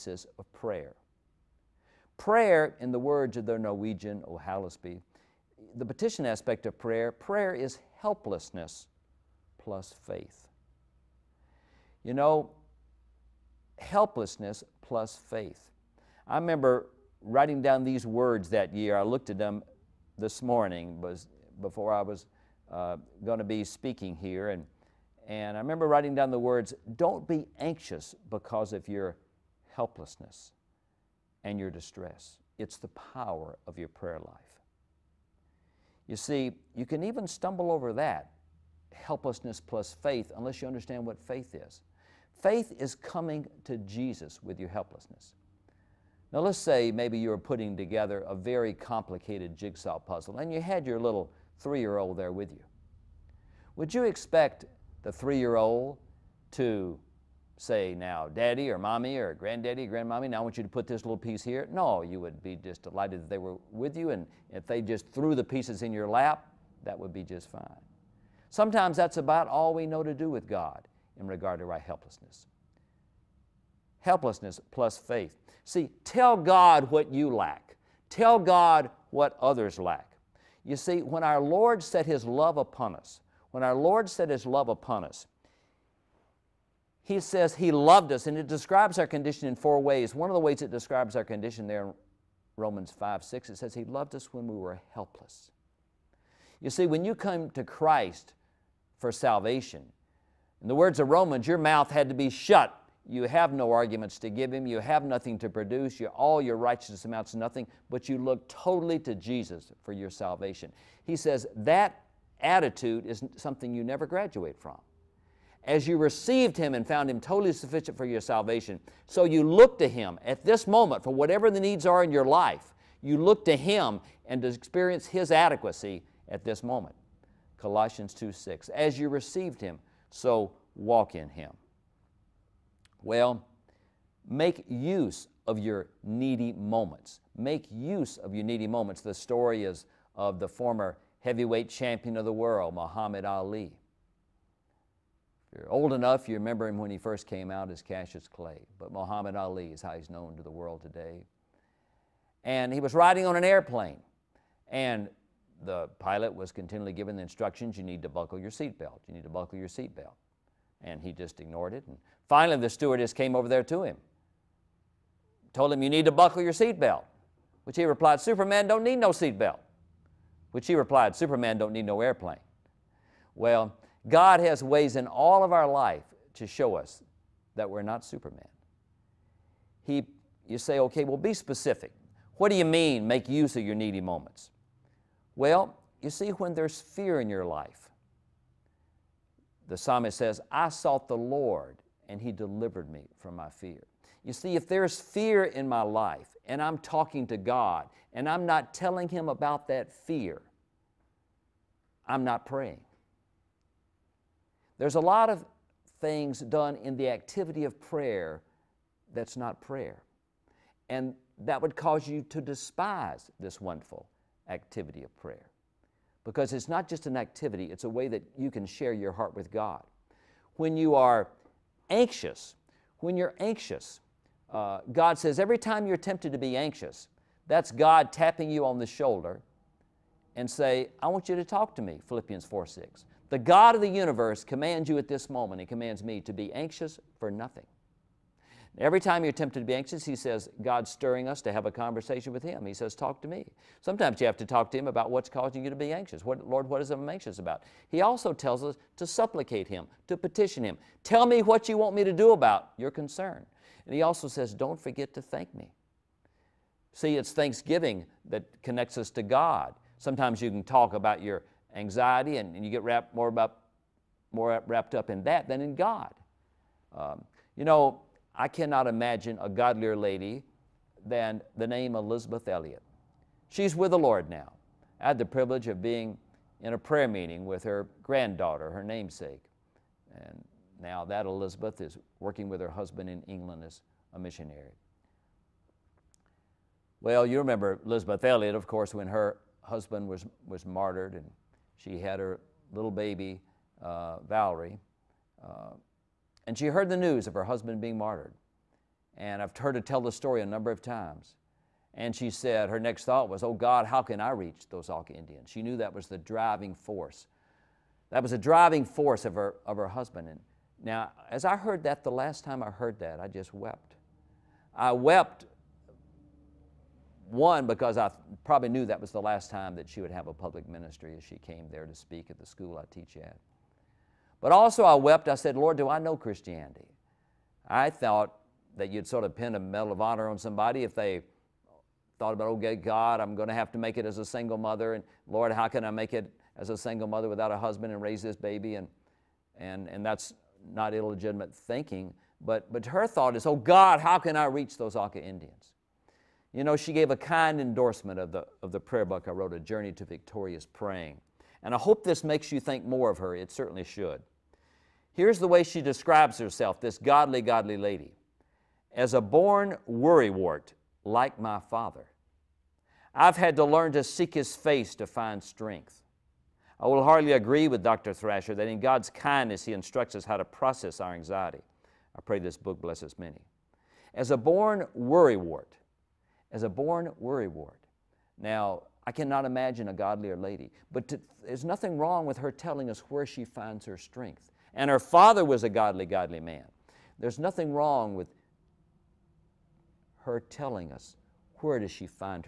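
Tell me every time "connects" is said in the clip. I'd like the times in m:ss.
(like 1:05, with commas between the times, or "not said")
4:18.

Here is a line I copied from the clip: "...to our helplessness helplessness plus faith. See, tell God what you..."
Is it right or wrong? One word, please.
right.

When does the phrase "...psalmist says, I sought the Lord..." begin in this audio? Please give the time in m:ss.
3:09.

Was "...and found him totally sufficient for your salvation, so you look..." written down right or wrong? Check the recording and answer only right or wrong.
right.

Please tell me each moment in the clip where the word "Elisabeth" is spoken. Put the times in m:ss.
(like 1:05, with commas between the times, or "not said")
4:31, 4:47.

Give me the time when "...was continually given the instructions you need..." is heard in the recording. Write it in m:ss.
2:36.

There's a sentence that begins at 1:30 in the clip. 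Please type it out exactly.
One of the ways it describes our condition there in Romans 5 6, it says He loved us when we were helpless.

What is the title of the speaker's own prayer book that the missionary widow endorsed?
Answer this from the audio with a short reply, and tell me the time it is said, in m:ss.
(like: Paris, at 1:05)
A Journey to Victorious Praying, at 5:49.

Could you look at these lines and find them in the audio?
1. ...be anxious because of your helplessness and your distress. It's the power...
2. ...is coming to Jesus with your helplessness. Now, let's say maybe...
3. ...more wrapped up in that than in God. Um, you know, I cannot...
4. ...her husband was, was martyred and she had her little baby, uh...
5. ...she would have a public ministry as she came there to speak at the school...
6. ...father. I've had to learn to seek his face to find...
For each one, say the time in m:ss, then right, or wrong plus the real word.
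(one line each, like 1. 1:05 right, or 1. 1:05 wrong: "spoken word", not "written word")
1. 0:27 right
2. 0:42 right
3. 4:24 right
4. 4:49 right
5. 5:19 right
6. 6:01 right.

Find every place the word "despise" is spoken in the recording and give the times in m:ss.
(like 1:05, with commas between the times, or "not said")
3:32.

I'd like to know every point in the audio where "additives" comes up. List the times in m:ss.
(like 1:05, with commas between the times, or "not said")
not said.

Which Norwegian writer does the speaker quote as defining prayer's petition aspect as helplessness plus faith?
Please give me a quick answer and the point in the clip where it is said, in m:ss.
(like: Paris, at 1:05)
O. Hallesby, at 0:04.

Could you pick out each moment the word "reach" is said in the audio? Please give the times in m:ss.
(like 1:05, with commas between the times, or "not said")
5:04, 5:44.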